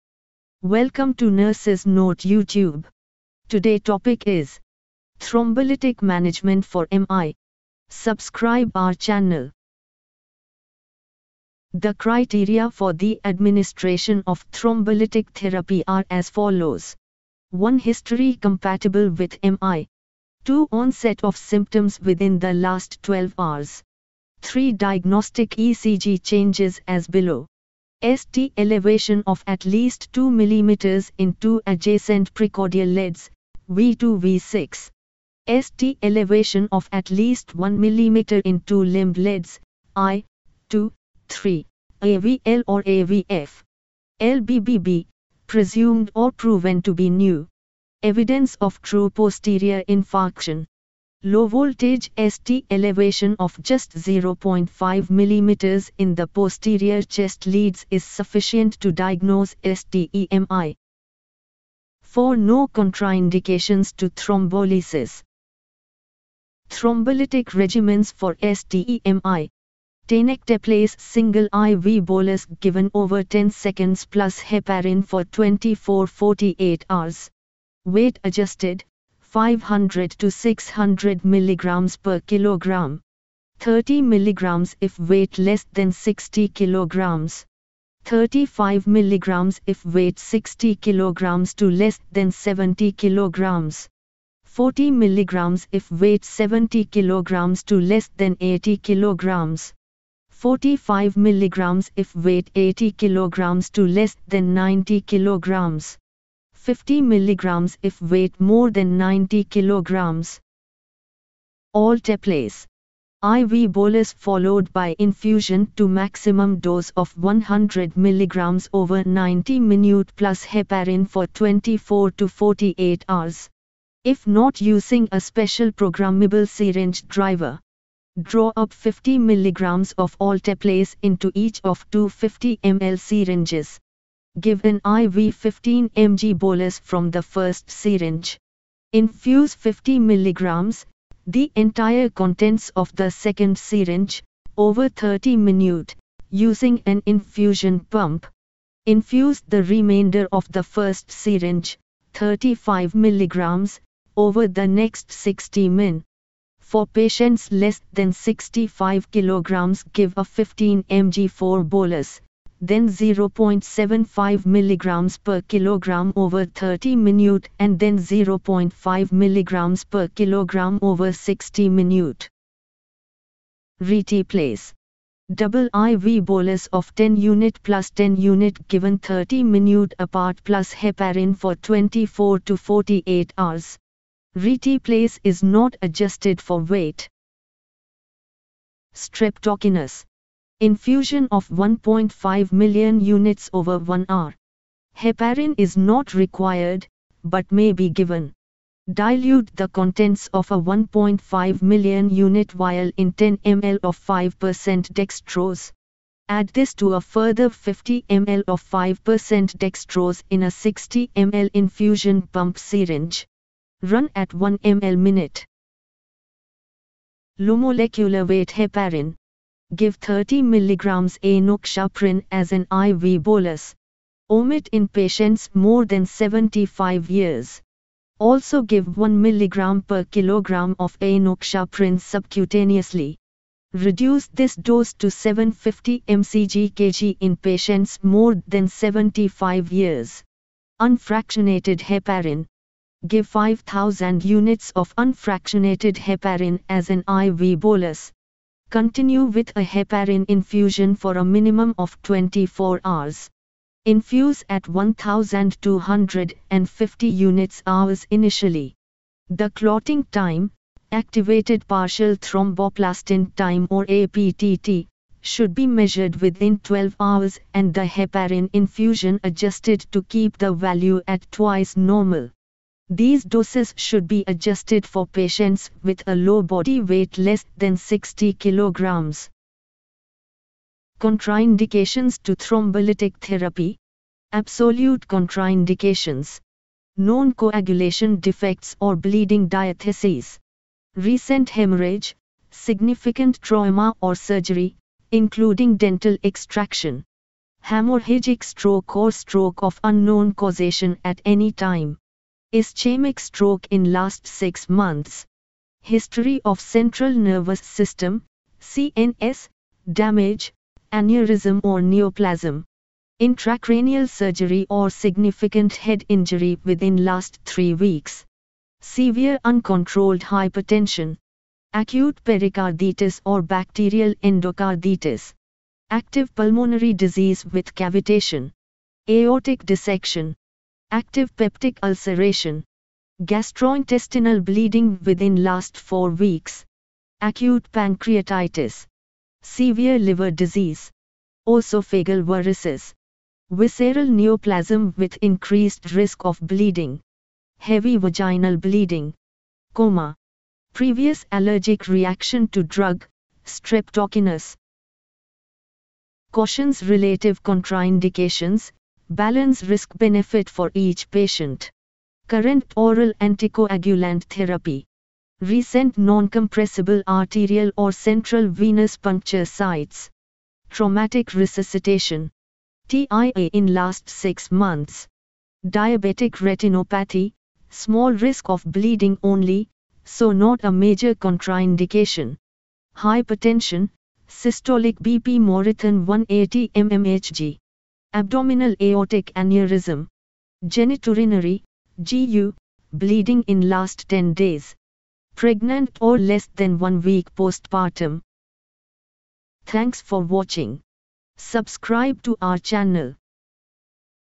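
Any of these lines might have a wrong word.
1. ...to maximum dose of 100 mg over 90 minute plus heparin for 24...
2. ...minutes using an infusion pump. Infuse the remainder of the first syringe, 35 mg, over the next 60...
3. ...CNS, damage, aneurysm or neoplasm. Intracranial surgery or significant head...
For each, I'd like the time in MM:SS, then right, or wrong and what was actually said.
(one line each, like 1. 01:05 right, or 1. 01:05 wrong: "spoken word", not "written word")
1. 01:55 right
2. 02:25 right
3. 05:08 right.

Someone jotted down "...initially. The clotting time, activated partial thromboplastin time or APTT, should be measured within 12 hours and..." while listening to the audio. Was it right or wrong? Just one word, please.
right.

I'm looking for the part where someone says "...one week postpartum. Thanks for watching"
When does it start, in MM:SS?
06:36.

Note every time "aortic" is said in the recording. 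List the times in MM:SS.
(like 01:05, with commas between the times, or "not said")
05:29, 06:28.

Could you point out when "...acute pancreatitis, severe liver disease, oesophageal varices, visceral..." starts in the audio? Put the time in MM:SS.
05:37.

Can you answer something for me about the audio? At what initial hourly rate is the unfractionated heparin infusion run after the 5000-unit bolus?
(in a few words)
1250 units per hour.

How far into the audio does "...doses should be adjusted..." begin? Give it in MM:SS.
04:33.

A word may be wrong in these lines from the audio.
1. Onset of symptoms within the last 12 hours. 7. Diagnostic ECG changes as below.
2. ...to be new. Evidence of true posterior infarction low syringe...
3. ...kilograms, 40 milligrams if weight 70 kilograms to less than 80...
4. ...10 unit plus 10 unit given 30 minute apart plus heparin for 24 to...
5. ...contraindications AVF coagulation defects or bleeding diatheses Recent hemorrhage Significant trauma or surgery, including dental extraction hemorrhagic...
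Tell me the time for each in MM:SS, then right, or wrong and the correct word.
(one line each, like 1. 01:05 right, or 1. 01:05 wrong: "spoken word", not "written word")
1. 00:20 wrong: "3", not "7"
2. 00:46 wrong: "voltage", not "syringe"
3. 01:32 right
4. 02:56 right
5. 04:45 wrong: "Known", not "AVF".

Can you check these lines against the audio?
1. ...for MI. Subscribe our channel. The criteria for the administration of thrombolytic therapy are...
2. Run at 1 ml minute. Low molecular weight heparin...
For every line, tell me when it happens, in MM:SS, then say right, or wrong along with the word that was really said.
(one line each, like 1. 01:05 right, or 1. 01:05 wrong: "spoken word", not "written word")
1. 00:06 right
2. 03:33 right.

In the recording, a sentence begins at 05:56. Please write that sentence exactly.
Cautions relative contraindications, Balance risk benefit for each patient.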